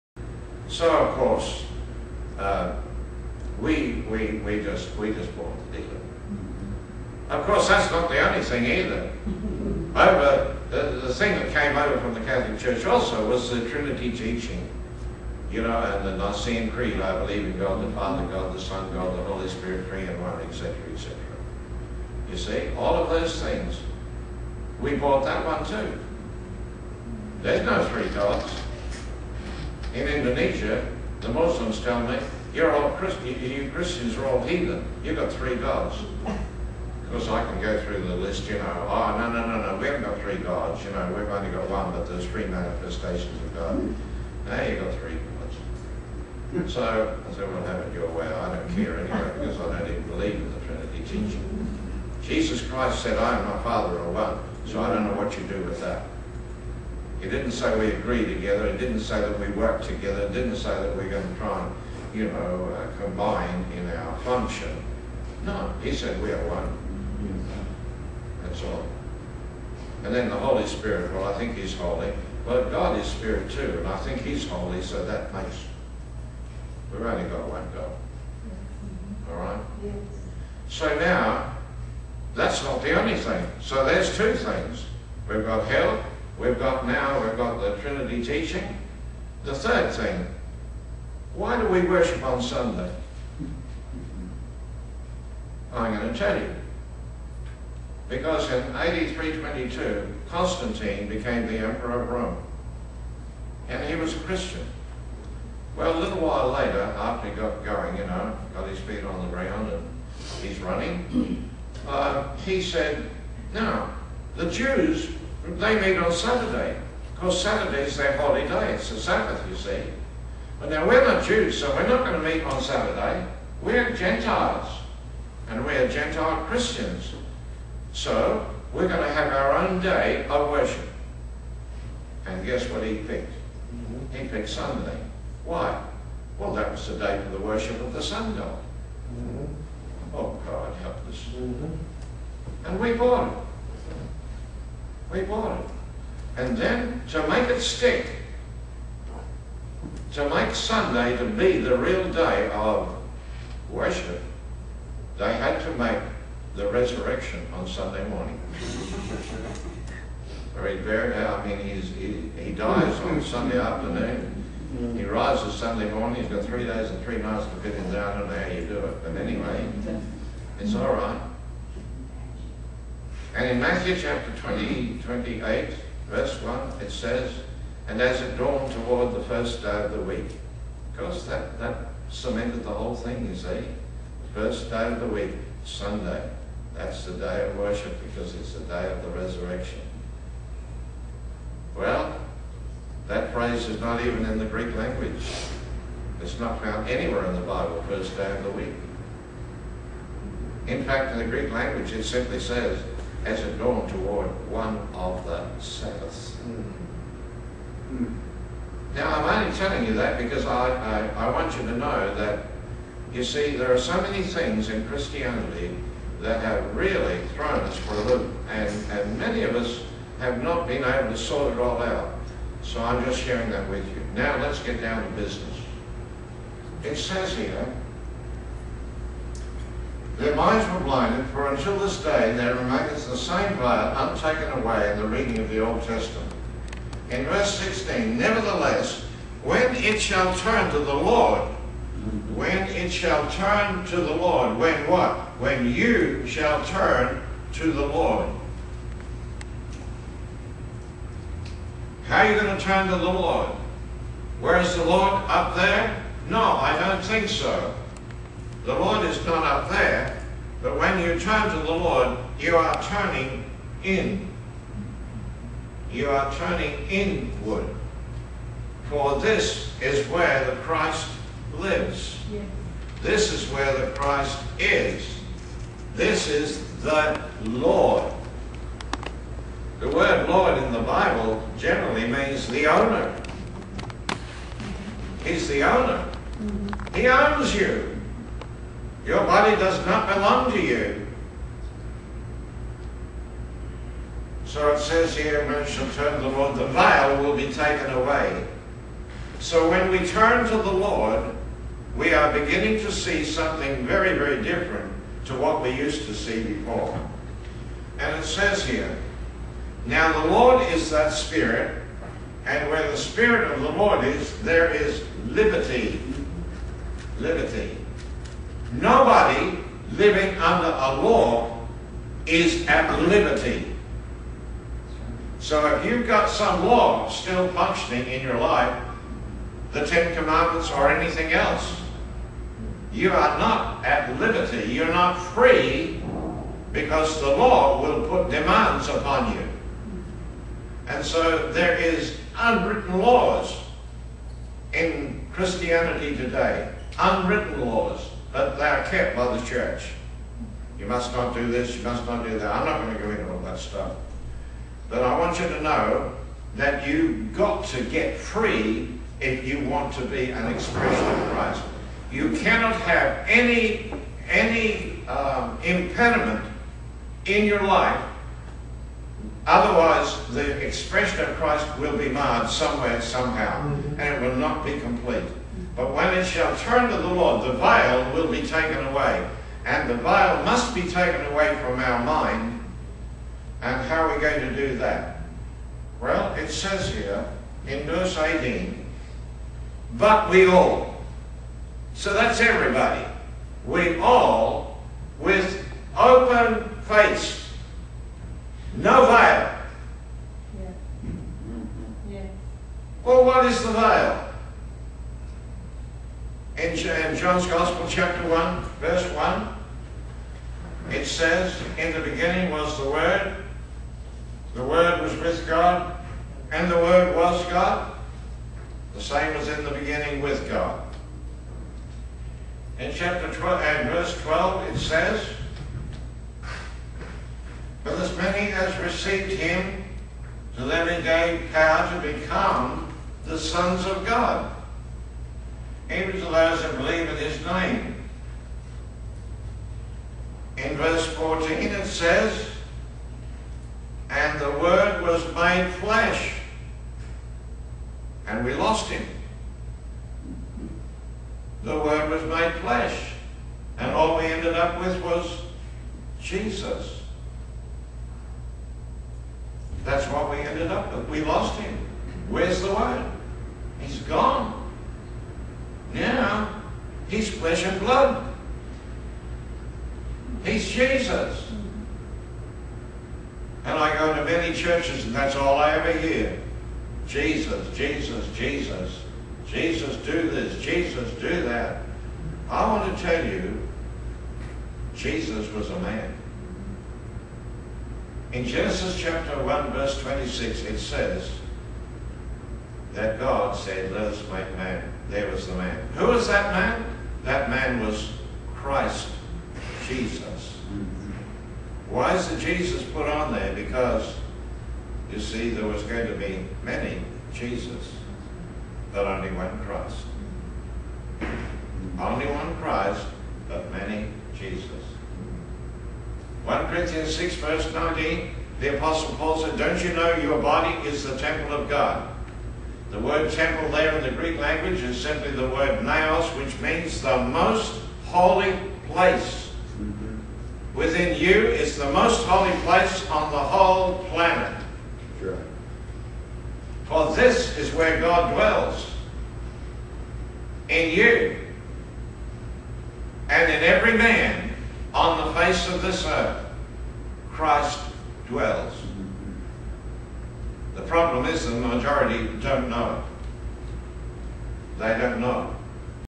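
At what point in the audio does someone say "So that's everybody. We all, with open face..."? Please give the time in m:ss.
6:31.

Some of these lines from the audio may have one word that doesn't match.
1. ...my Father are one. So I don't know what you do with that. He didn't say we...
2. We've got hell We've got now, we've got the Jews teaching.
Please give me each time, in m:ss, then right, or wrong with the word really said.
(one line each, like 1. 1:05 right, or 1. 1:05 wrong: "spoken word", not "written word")
1. 0:53 right
2. 1:25 wrong: "Trinity", not "Jews".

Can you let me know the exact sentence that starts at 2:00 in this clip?
But now we're not Jews, so we're not going to meet on Saturday.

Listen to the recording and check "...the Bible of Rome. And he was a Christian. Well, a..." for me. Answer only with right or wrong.
wrong.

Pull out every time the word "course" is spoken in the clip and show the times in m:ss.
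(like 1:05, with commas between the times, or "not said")
0:01, 0:07, 0:37.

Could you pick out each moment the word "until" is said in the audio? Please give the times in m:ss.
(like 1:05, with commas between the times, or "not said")
3:51.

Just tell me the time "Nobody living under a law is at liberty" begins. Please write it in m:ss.
5:18.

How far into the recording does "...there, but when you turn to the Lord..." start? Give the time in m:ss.
4:19.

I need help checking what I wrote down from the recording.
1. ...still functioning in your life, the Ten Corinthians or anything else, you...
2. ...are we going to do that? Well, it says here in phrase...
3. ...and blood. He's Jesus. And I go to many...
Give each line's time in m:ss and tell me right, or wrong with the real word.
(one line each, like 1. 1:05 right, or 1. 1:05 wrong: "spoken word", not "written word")
1. 5:27 wrong: "Commandments", not "Corinthians"
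2. 6:24 wrong: "verse", not "phrase"
3. 7:47 right.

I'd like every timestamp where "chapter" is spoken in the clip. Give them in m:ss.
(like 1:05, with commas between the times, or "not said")
2:53, 6:47, 7:02, 8:08.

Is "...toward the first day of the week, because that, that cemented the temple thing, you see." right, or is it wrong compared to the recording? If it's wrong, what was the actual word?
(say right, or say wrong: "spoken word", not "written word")
wrong: "whole", not "temple".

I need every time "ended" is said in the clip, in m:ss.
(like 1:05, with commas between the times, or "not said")
7:34, 7:40.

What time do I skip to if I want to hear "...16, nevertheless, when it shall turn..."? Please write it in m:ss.
3:57.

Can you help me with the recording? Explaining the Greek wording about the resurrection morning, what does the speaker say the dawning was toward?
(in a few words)
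one of the Sabbaths.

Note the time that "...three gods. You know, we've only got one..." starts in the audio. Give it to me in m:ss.
0:40.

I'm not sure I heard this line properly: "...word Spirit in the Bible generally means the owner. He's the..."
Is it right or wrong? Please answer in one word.
wrong.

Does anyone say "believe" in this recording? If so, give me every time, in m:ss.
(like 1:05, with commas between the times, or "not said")
0:17, 0:50, 7:16.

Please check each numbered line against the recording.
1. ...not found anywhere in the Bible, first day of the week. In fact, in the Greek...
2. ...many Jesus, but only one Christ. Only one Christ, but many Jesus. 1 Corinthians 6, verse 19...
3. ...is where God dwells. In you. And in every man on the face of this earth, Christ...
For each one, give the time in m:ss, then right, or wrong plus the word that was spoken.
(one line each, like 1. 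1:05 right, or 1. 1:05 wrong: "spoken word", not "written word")
1. 3:16 right
2. 8:26 right
3. 8:57 right.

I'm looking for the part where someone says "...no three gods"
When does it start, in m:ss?
0:27.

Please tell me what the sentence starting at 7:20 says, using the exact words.
In verse 14 it says, And the Word was made flesh, and we lost him.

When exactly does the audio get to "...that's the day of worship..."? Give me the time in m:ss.
3:06.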